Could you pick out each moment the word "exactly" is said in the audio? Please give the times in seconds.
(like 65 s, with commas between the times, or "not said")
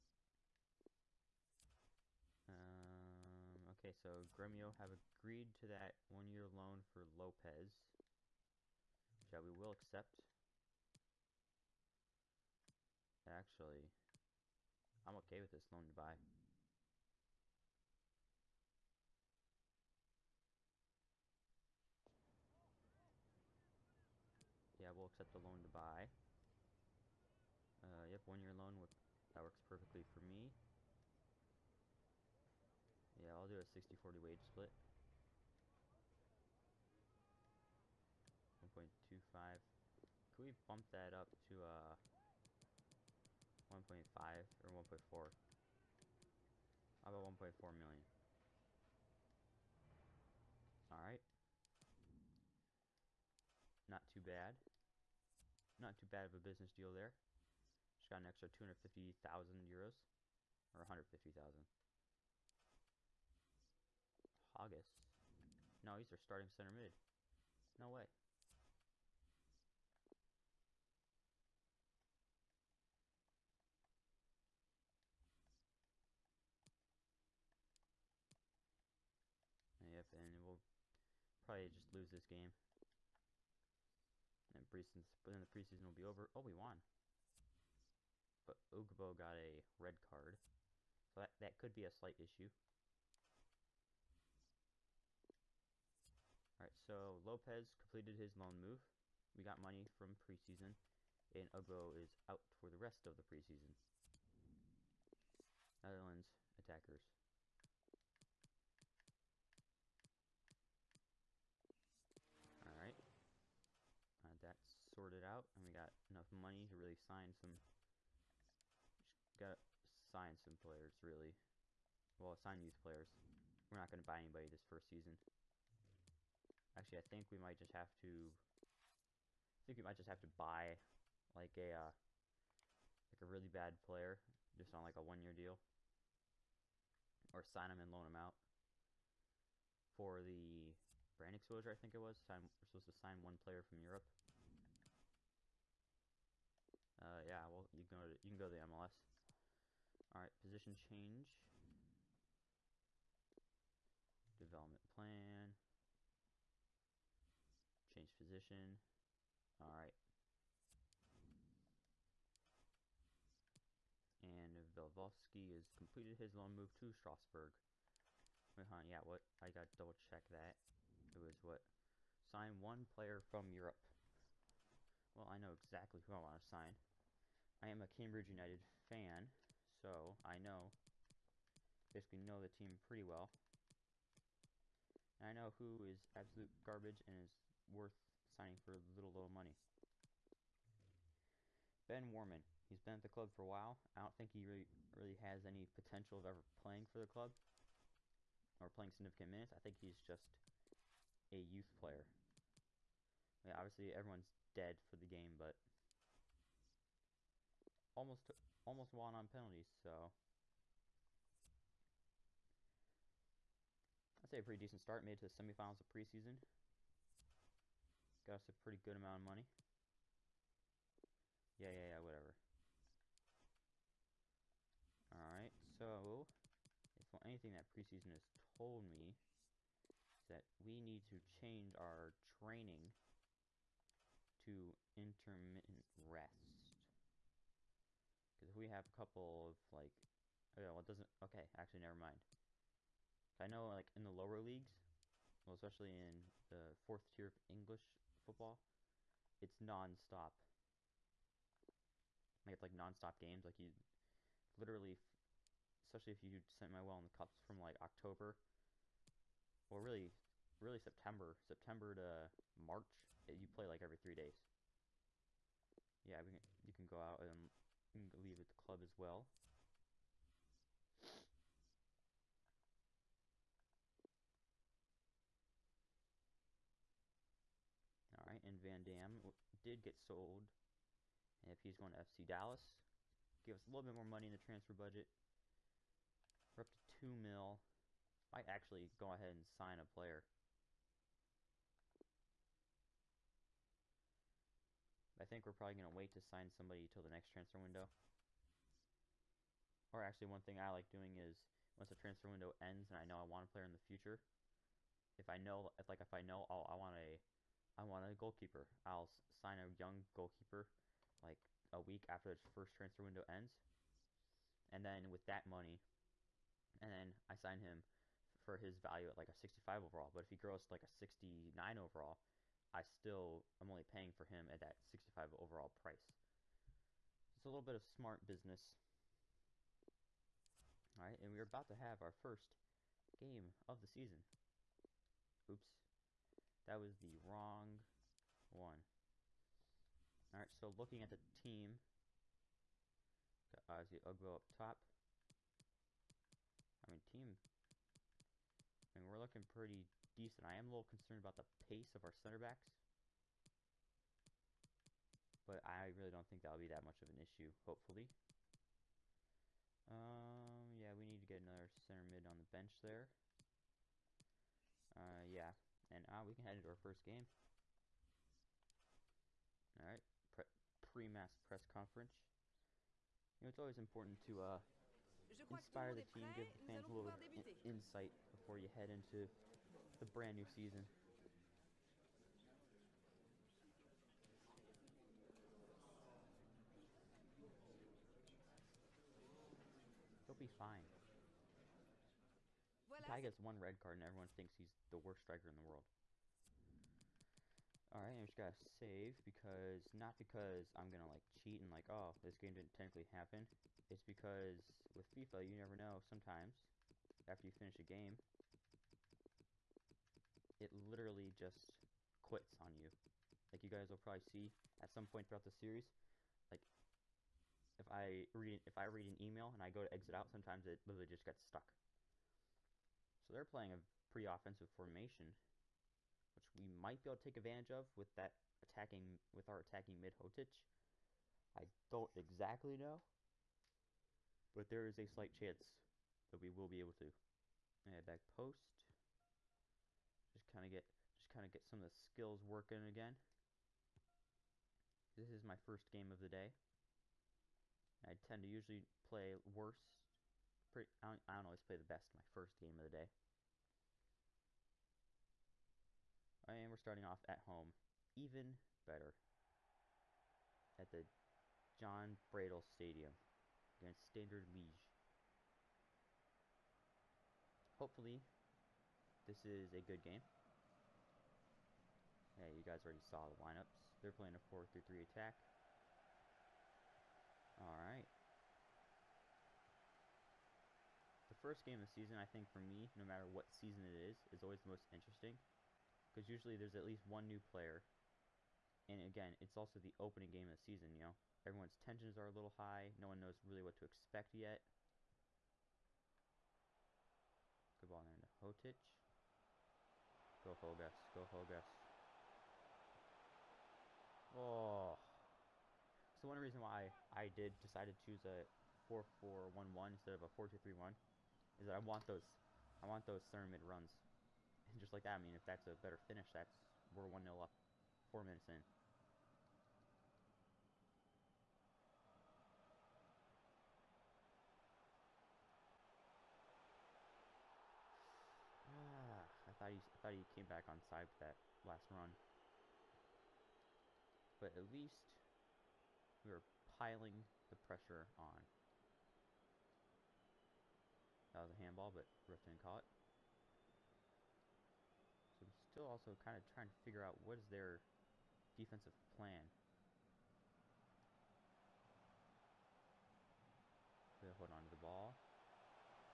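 175 s, 432 s.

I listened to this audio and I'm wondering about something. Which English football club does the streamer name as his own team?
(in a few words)
Cambridge United.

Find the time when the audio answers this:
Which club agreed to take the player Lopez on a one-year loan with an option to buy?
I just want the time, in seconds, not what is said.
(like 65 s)
4 s.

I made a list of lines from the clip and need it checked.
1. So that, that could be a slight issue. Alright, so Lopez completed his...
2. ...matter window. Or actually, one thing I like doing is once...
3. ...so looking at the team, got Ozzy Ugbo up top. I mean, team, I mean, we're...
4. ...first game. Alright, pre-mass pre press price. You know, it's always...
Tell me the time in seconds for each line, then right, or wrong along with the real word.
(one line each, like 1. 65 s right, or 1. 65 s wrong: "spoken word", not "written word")
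1. 91 s right
2. 297 s wrong: "transfer", not "matter"
3. 340 s right
4. 366 s wrong: "conference", not "price".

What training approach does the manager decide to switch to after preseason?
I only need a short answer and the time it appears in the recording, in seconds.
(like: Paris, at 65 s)
Intermittent rest, at 234 s.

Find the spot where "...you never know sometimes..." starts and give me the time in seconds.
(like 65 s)
405 s.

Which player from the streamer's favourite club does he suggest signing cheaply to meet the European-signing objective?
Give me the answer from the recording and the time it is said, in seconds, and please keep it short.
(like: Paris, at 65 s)
Ben Worman, at 191 s.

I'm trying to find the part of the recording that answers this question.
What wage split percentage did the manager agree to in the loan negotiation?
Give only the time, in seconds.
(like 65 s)
33 s.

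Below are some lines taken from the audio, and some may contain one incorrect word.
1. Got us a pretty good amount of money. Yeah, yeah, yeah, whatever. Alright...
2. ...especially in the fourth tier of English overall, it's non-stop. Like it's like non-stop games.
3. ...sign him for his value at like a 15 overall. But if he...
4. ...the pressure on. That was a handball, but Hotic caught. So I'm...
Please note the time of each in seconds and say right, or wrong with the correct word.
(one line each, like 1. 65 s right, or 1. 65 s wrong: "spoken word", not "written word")
1. 218 s right
2. 245 s wrong: "football", not "overall"
3. 317 s wrong: "65", not "15"
4. 537 s wrong: "Ruffin", not "Hotic".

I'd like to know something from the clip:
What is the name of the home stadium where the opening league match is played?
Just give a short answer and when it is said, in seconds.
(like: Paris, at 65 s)
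Jan Breydel Stadium, at 461 s.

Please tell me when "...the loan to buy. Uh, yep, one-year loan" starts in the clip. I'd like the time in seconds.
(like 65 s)
25 s.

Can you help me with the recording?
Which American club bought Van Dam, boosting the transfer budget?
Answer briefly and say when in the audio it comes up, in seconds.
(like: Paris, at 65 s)
FC Dallas, at 281 s.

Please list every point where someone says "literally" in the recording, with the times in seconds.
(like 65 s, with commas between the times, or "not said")
254 s, 410 s, 420 s.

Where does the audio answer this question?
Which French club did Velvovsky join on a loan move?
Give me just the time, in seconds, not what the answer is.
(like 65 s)
166 s.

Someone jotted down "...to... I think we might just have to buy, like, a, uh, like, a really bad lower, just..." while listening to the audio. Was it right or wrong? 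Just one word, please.
wrong.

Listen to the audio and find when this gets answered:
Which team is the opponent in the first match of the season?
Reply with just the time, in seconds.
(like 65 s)
464 s.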